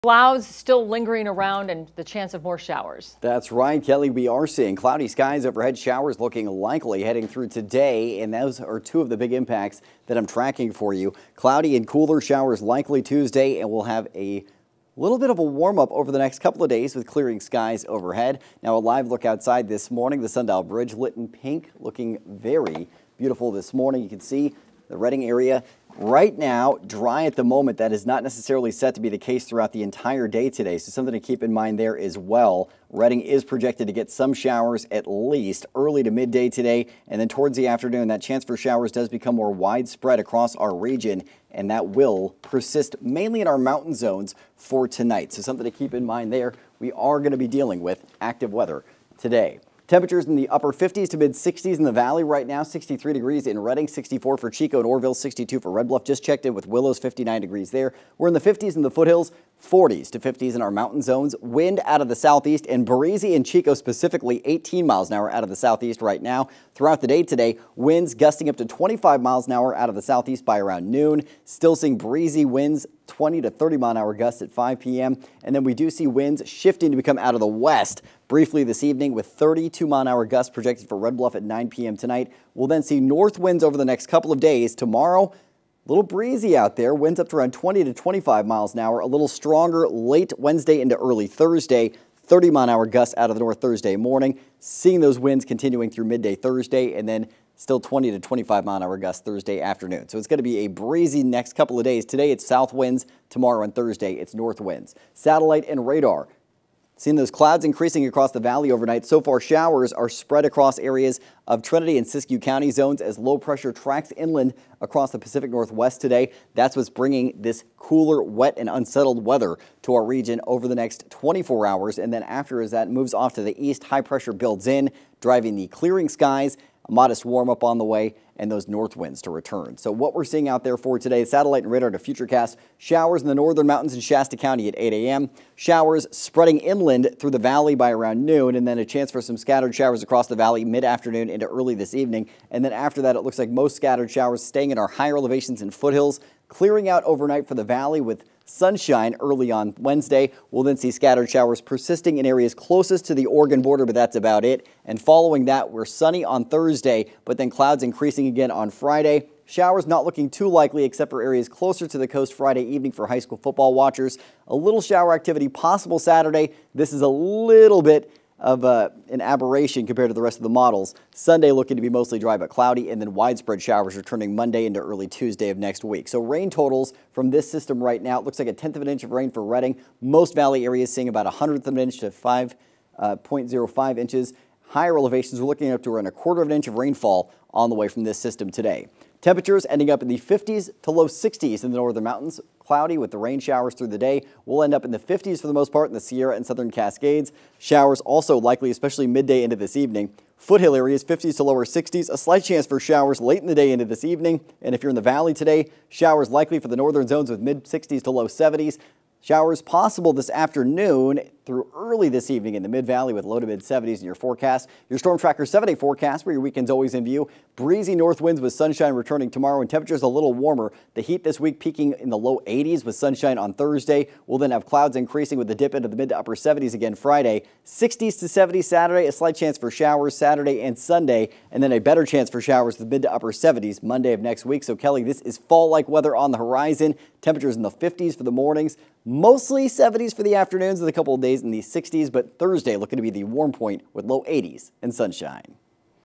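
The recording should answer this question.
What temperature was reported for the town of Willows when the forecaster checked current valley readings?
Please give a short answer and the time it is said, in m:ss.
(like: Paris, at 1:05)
59 degrees, at 0:56.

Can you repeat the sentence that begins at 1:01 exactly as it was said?
Wind out of the southeast and breezy in Chico specifically 18 miles an hour out of the southeast right now.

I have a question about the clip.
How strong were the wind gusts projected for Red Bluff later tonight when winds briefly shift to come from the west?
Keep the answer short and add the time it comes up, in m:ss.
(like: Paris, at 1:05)
32 mph, at 1:19.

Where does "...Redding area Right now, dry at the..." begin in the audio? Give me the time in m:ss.
0:24.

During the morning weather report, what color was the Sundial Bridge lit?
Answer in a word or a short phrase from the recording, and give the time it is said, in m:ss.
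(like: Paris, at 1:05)
Pink, at 0:21.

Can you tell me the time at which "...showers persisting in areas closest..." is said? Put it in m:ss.
2:31.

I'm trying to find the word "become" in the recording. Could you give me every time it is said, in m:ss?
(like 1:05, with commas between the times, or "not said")
0:39, 1:16.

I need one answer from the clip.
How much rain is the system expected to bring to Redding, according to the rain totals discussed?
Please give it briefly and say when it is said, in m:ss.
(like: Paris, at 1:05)
A tenth of an inch, at 2:58.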